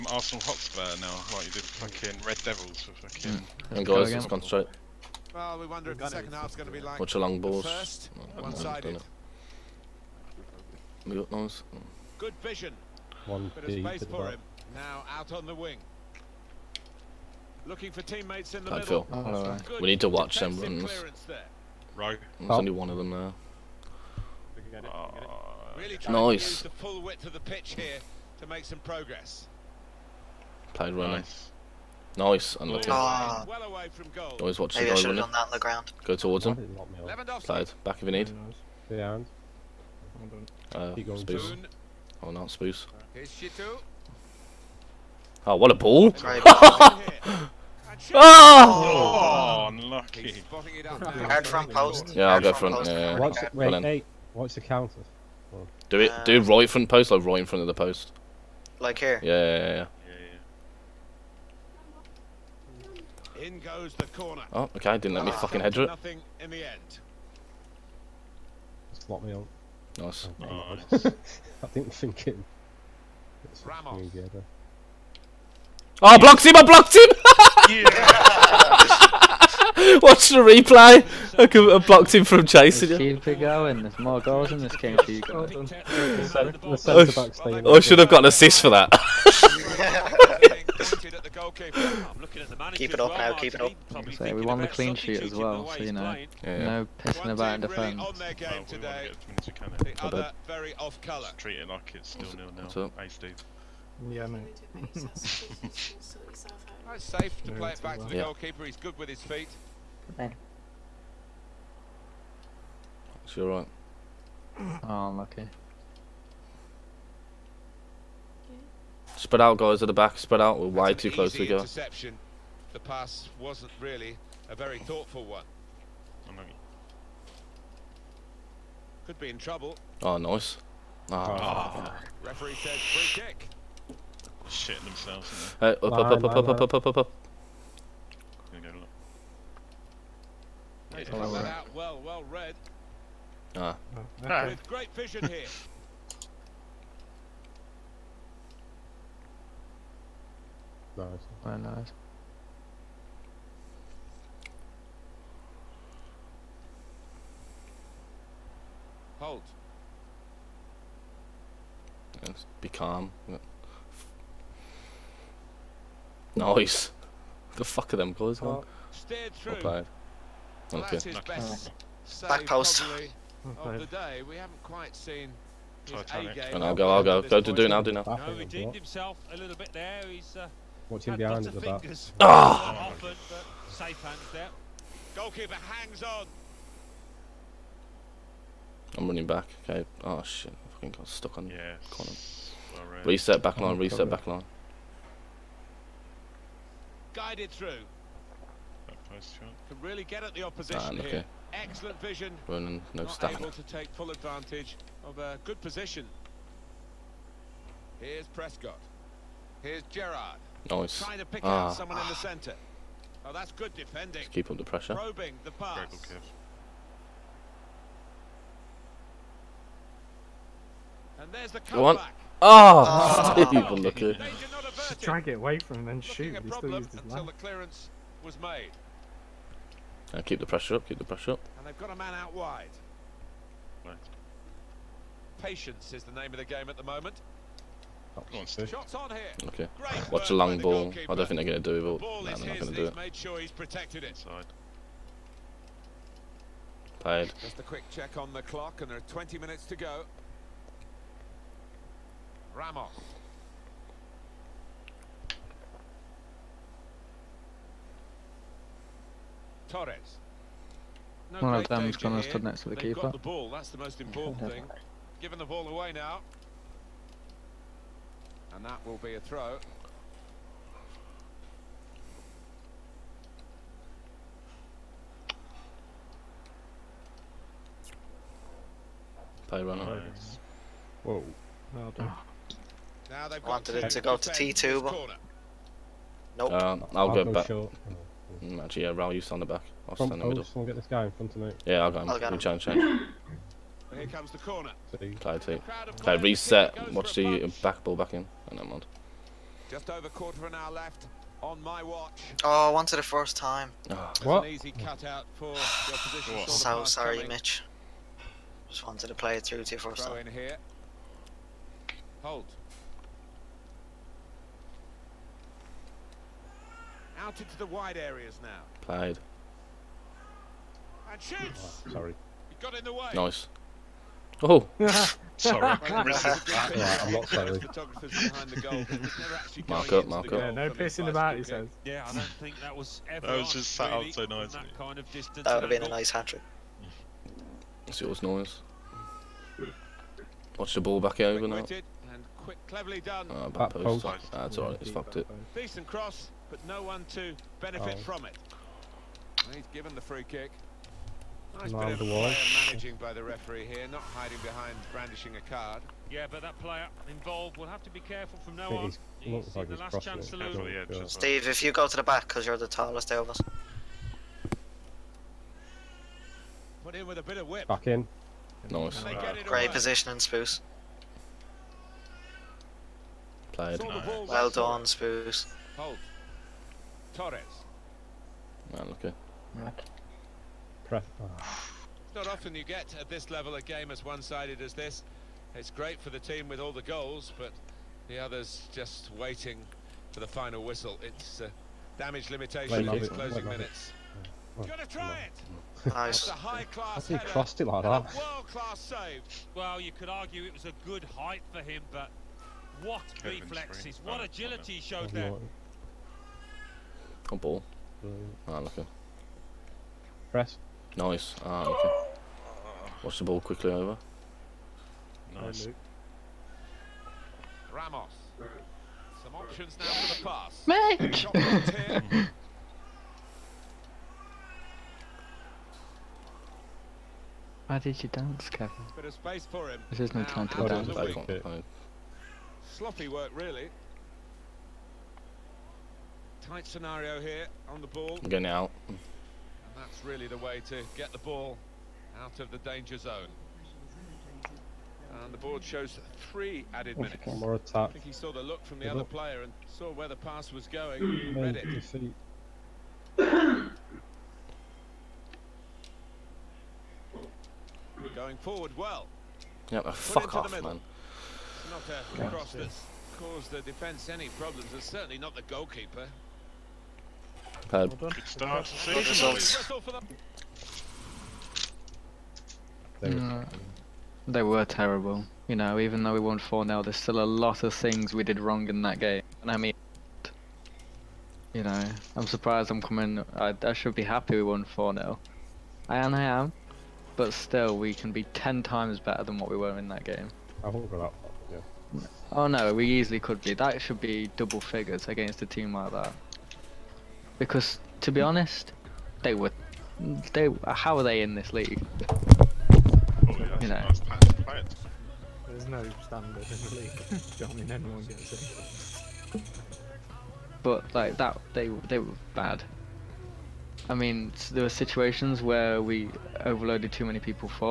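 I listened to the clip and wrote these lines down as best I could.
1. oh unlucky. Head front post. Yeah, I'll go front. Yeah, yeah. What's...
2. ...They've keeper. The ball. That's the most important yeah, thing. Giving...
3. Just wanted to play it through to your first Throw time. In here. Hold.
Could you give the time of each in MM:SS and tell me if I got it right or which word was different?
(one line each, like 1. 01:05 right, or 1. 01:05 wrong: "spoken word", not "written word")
1. 00:49 right
2. 04:22 right
3. 05:08 right.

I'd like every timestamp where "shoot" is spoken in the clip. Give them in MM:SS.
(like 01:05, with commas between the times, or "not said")
03:46, 05:21.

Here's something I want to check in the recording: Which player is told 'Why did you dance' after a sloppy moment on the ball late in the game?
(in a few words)
Kevin.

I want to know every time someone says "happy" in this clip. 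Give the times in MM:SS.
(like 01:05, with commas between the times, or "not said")
08:04.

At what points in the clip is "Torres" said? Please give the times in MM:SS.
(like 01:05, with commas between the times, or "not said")
04:19, 06:17.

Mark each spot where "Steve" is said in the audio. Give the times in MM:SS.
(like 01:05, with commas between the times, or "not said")
01:43, 06:01.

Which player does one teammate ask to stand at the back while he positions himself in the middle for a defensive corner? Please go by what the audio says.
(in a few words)
Raul.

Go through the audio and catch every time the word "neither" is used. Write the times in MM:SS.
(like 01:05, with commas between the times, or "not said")
not said.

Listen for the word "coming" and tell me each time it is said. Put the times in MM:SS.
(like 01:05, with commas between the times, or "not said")
05:07, 08:02.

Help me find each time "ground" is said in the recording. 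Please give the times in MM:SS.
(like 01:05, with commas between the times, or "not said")
00:35.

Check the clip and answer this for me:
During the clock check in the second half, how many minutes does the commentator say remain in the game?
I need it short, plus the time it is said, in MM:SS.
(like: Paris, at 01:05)
20, at 04:08.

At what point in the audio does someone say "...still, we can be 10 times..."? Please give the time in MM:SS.
08:07.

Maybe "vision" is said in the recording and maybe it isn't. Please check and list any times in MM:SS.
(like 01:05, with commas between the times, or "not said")
00:12, 02:24, 03:22.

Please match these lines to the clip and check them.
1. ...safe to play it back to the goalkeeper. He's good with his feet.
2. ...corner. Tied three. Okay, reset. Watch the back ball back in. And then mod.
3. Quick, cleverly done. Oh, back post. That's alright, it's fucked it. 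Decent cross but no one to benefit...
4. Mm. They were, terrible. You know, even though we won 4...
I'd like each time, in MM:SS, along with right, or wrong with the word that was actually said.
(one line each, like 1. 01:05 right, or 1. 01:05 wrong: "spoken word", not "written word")
1. 01:47 right
2. 04:54 wrong: "two", not "three"
3. 05:42 right
4. 07:53 right.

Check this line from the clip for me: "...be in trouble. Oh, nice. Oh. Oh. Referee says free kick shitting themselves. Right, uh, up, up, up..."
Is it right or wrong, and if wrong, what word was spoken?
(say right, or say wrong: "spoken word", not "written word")
right.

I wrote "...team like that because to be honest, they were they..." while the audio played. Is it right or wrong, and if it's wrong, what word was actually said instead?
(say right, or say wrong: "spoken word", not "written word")
right.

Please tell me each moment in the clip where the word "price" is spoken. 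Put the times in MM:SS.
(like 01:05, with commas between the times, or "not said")
not said.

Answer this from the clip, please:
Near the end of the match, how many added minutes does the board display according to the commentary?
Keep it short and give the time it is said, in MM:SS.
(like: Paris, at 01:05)
3, at 07:25.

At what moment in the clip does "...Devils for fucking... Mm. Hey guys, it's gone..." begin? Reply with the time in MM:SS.
00:02.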